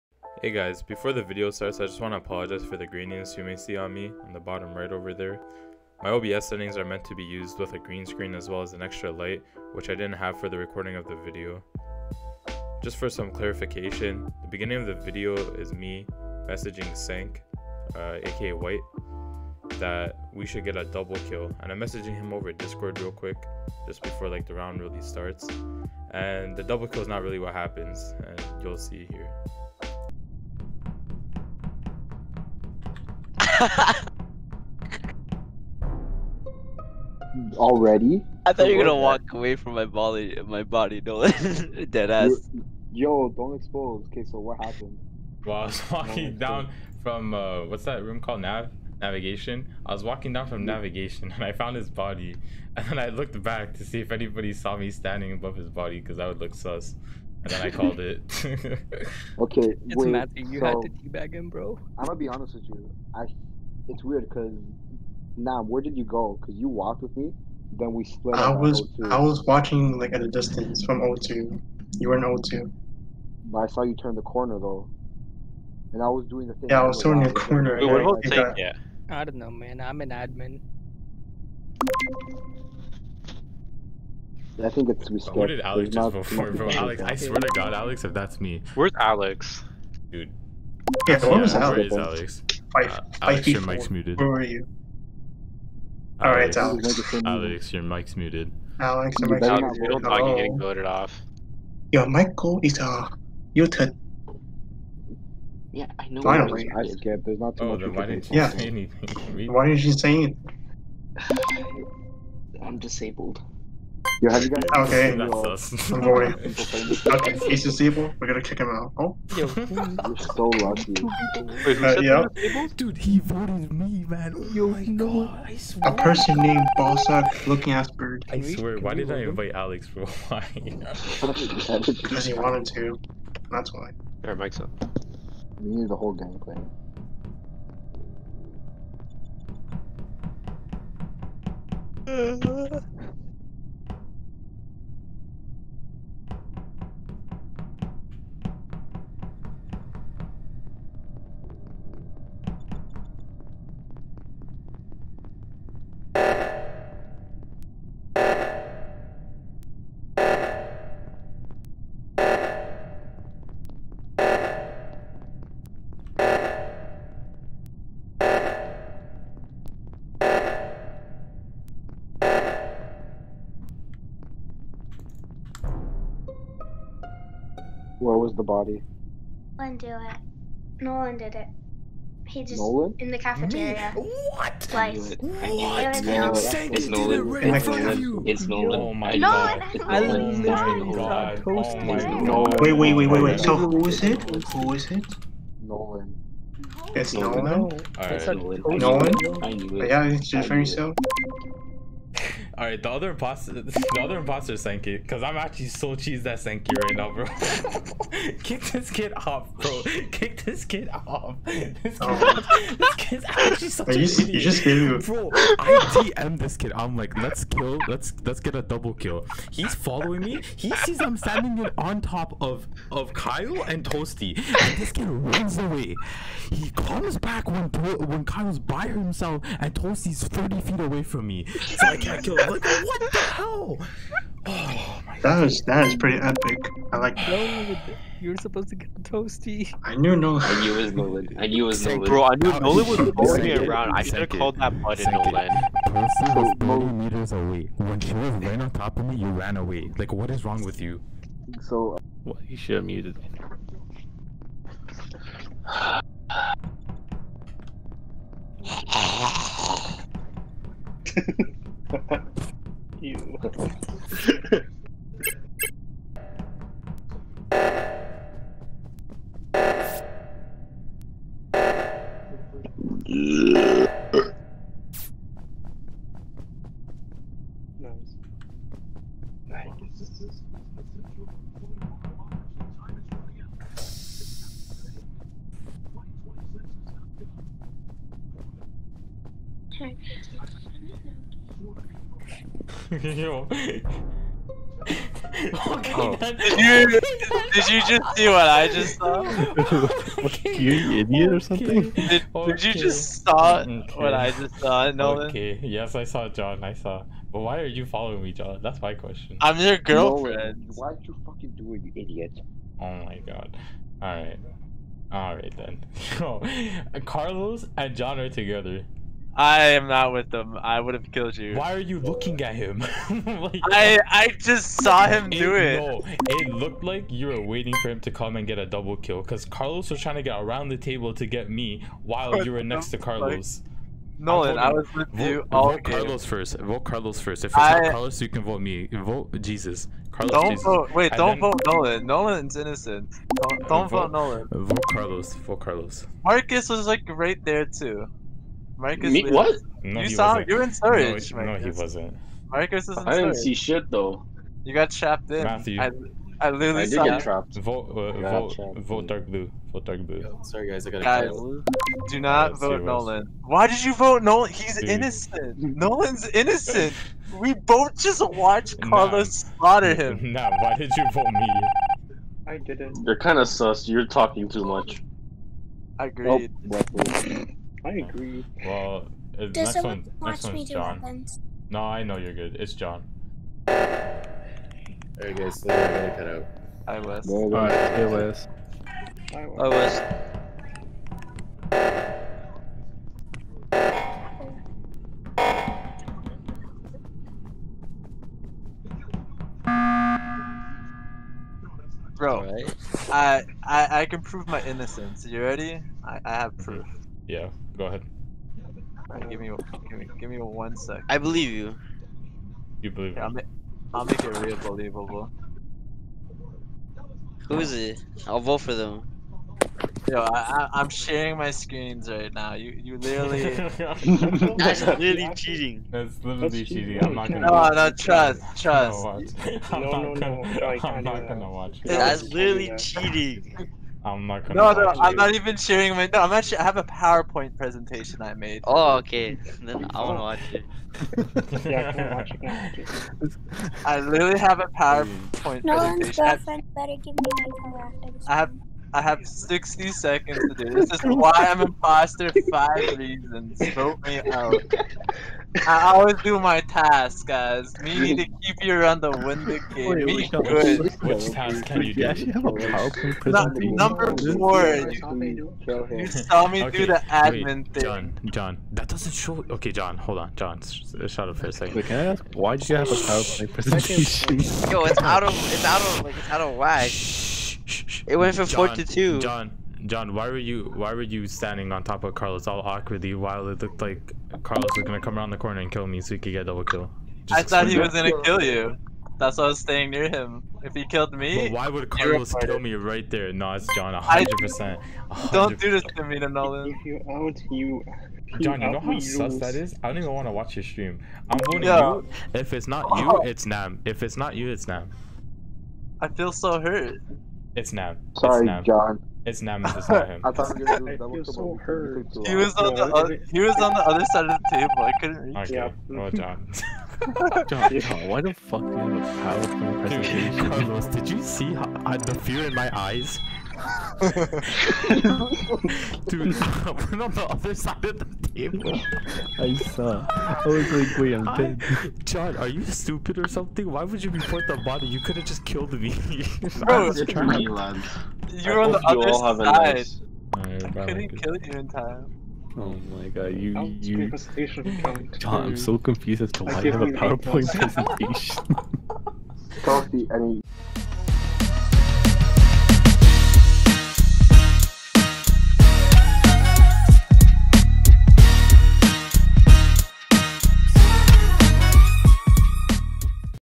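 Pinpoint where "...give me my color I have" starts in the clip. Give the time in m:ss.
7:27.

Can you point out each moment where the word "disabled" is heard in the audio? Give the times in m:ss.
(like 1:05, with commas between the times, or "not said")
1:52, 1:57.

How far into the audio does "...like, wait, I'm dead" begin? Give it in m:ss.
8:50.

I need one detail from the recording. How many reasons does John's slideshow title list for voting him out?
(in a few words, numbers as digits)
5.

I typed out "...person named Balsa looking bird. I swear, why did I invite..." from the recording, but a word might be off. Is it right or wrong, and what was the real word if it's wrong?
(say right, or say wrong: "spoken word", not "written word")
right.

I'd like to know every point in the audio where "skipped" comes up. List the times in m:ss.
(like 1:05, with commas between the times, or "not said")
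1:25, 1:46.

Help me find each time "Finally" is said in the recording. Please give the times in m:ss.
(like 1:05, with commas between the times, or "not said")
1:46.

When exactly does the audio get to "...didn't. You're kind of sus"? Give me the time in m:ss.
6:12.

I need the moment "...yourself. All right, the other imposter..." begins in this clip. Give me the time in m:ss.
3:20.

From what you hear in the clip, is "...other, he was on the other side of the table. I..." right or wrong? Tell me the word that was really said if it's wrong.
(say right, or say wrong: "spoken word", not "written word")
right.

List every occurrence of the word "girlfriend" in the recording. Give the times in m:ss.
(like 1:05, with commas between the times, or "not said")
5:09, 7:26.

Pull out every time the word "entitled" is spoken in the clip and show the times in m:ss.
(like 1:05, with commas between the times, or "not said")
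not said.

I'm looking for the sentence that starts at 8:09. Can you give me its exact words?
That's why I was staying near him.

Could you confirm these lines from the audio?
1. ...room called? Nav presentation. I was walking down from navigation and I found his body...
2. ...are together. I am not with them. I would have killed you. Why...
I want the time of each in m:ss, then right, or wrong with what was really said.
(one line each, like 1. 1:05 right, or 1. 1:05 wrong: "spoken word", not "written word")
1. 0:48 wrong: "navigation", not "presentation"
2. 5:18 right.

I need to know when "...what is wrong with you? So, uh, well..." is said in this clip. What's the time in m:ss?
4:10.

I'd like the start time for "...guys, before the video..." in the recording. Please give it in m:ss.
0:00.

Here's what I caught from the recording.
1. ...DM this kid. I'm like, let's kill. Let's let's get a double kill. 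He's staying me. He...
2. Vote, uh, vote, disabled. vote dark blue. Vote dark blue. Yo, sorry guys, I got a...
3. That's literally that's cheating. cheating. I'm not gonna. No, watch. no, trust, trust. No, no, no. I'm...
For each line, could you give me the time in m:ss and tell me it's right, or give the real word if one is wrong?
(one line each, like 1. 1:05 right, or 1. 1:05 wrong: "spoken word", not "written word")
1. 3:36 wrong: "following", not "staying"
2. 5:57 wrong: "trapped", not "disabled"
3. 7:05 right.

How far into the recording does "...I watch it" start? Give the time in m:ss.
7:22.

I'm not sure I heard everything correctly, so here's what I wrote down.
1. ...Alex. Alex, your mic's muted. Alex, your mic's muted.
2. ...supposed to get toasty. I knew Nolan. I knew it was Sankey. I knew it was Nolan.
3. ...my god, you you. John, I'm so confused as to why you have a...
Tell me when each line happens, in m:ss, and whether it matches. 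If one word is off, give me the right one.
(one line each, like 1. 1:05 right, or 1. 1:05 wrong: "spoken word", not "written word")
1. 1:36 right
2. 3:58 wrong: "Nolan", not "Sankey"
3. 9:02 right.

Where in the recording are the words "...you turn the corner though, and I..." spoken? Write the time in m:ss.
1:13.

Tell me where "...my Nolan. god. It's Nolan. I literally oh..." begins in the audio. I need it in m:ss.
3:08.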